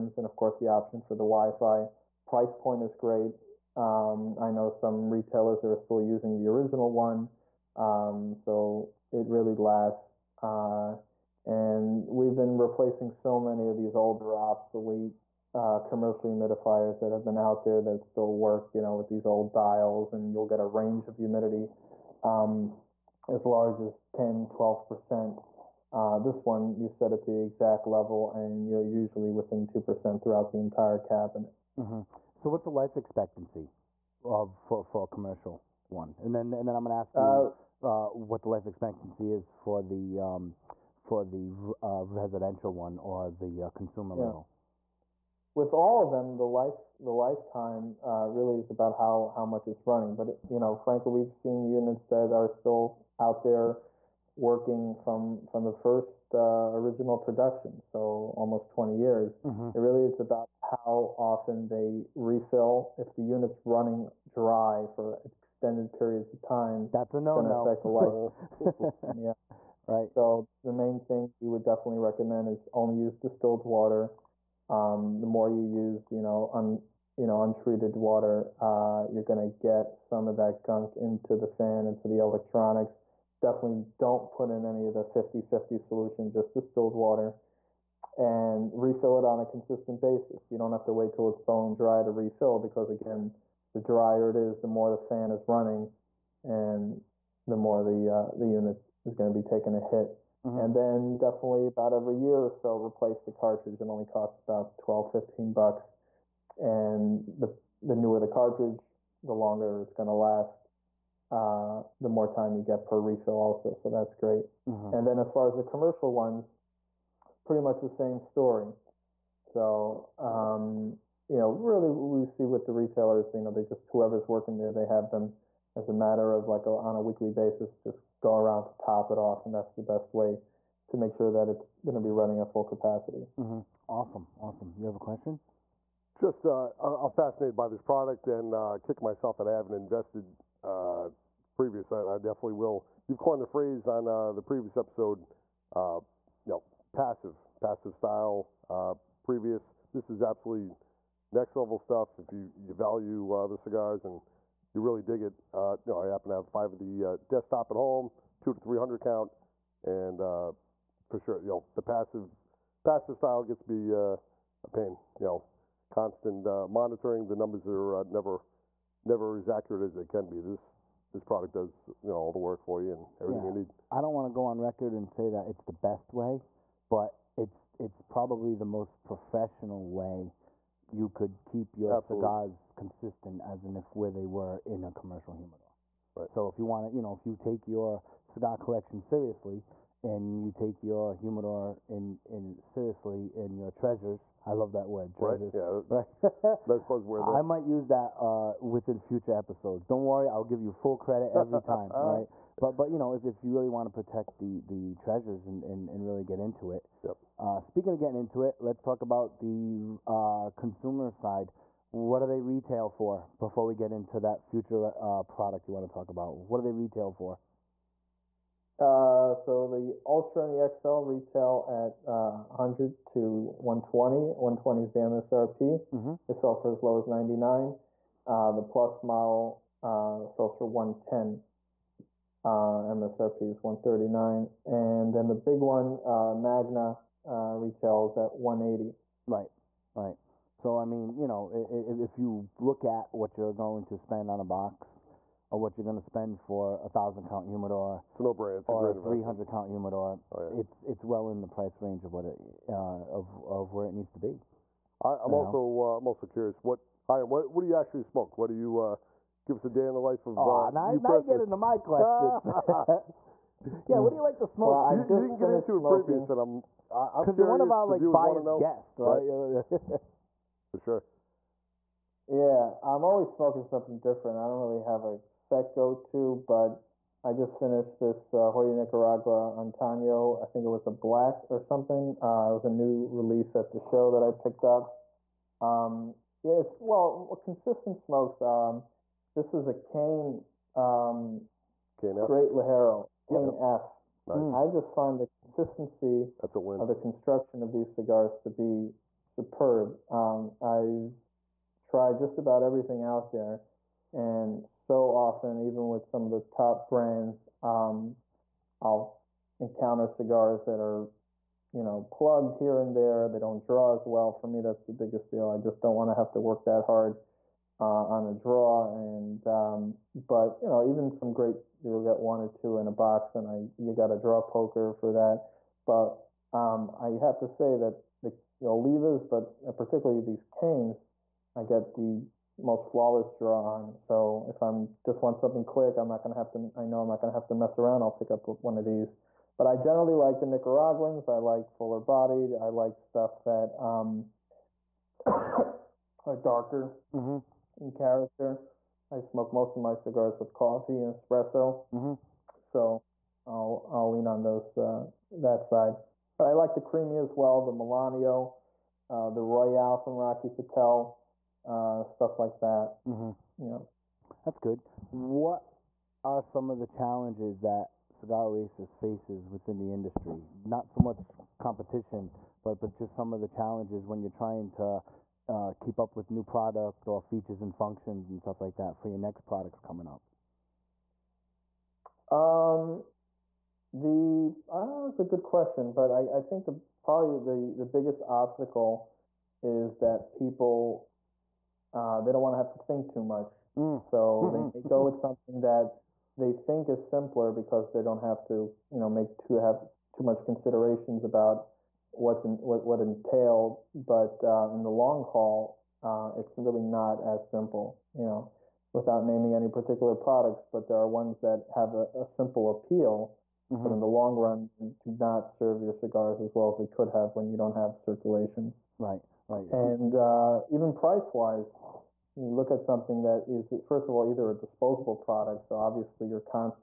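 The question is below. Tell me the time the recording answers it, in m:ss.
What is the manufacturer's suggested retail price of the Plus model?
3:53.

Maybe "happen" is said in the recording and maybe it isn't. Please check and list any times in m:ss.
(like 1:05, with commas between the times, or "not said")
2:36.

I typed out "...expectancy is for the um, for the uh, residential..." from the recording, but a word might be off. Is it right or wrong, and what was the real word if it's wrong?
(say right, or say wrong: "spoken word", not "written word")
right.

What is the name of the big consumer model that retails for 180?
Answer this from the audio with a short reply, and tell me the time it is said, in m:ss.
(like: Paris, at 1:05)
Magna, at 3:56.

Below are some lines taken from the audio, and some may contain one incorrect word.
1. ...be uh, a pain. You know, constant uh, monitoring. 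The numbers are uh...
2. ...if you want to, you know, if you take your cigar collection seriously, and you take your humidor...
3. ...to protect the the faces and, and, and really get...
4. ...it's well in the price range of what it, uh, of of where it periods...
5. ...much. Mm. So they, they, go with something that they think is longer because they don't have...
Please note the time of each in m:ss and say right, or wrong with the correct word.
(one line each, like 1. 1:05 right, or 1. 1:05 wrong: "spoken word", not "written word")
1. 2:43 right
2. 3:06 right
3. 3:23 wrong: "treasures", not "faces"
4. 4:10 wrong: "needs", not "periods"
5. 6:33 wrong: "simpler", not "longer".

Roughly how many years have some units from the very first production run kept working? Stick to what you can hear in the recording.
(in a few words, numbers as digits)
20 years.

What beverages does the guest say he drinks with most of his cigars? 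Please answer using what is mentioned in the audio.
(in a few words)
Coffee and espresso.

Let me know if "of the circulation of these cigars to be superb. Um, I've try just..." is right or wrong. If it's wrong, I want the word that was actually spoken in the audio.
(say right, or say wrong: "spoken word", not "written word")
wrong: "construction", not "circulation".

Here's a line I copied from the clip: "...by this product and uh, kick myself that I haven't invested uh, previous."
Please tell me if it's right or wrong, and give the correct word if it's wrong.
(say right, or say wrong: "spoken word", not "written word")
right.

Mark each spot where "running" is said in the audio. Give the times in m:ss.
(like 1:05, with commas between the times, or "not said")
0:49, 1:03, 1:35, 2:12.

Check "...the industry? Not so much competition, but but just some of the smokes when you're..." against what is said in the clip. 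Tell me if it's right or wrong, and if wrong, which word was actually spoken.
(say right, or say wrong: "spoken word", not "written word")
wrong: "challenges", not "smokes".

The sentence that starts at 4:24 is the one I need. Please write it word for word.
Well, you, you, didn't get into smoking.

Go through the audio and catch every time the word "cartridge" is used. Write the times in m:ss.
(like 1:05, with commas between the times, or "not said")
1:43, 1:48.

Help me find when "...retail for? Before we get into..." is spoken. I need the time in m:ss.
3:32.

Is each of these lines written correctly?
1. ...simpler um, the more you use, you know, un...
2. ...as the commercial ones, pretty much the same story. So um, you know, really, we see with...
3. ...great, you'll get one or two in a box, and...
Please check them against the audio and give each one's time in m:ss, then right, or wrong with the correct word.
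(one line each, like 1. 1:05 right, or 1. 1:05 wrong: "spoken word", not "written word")
1. 1:13 wrong: "water", not "simpler"
2. 1:55 right
3. 5:21 right.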